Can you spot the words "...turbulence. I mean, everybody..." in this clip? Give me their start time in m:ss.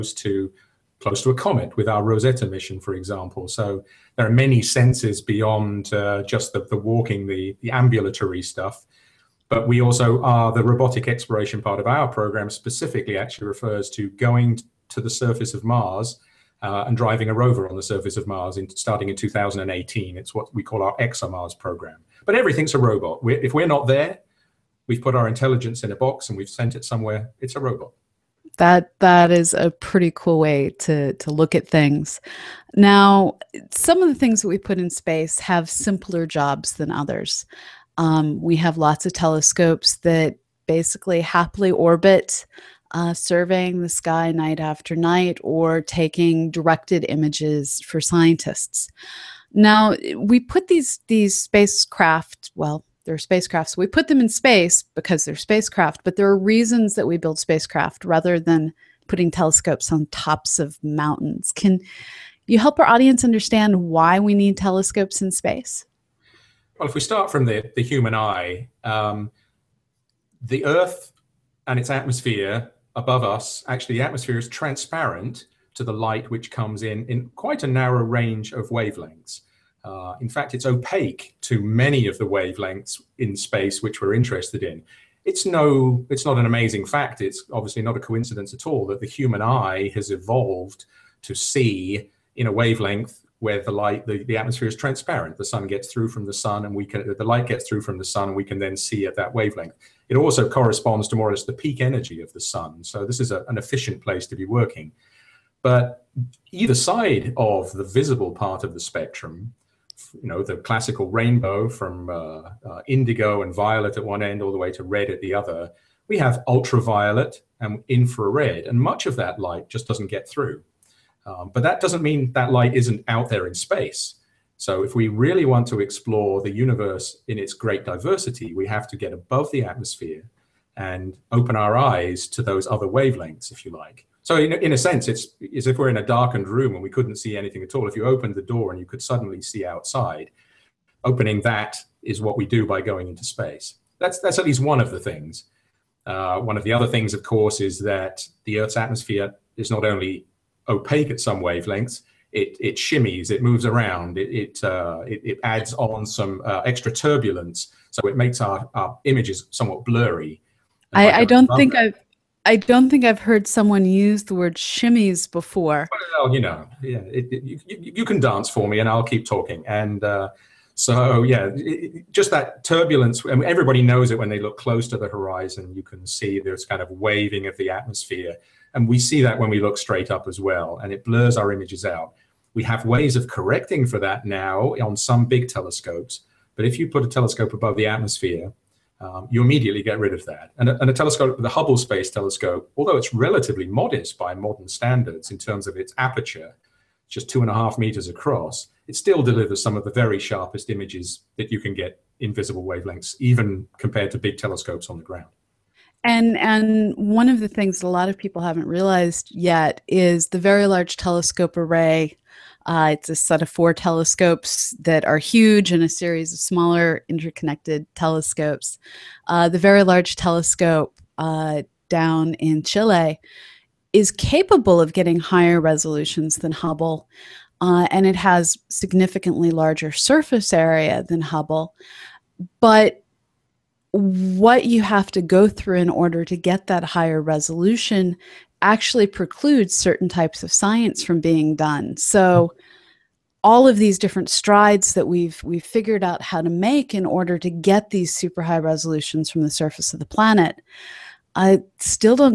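2:52.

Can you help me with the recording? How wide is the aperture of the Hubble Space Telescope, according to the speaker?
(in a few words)
2.5 meters.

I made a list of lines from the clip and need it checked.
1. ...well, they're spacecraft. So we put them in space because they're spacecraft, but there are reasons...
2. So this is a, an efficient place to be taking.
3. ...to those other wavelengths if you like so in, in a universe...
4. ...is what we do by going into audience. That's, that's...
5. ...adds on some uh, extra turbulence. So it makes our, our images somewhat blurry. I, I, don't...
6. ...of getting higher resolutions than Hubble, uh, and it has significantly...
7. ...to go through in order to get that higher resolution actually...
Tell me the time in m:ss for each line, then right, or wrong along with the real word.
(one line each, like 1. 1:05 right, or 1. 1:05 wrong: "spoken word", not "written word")
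1. 0:52 right
2. 1:42 wrong: "working", not "taking"
3. 2:12 wrong: "sense", not "universe"
4. 2:22 wrong: "space", not "audience"
5. 2:35 right
6. 3:44 right
7. 3:55 right.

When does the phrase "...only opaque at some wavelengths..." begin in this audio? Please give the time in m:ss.
2:29.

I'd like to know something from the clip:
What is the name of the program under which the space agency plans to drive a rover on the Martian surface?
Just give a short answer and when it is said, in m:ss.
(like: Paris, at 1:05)
ExoMars, at 0:20.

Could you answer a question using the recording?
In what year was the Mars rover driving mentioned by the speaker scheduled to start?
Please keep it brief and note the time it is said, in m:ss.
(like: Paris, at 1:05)
2018, at 0:19.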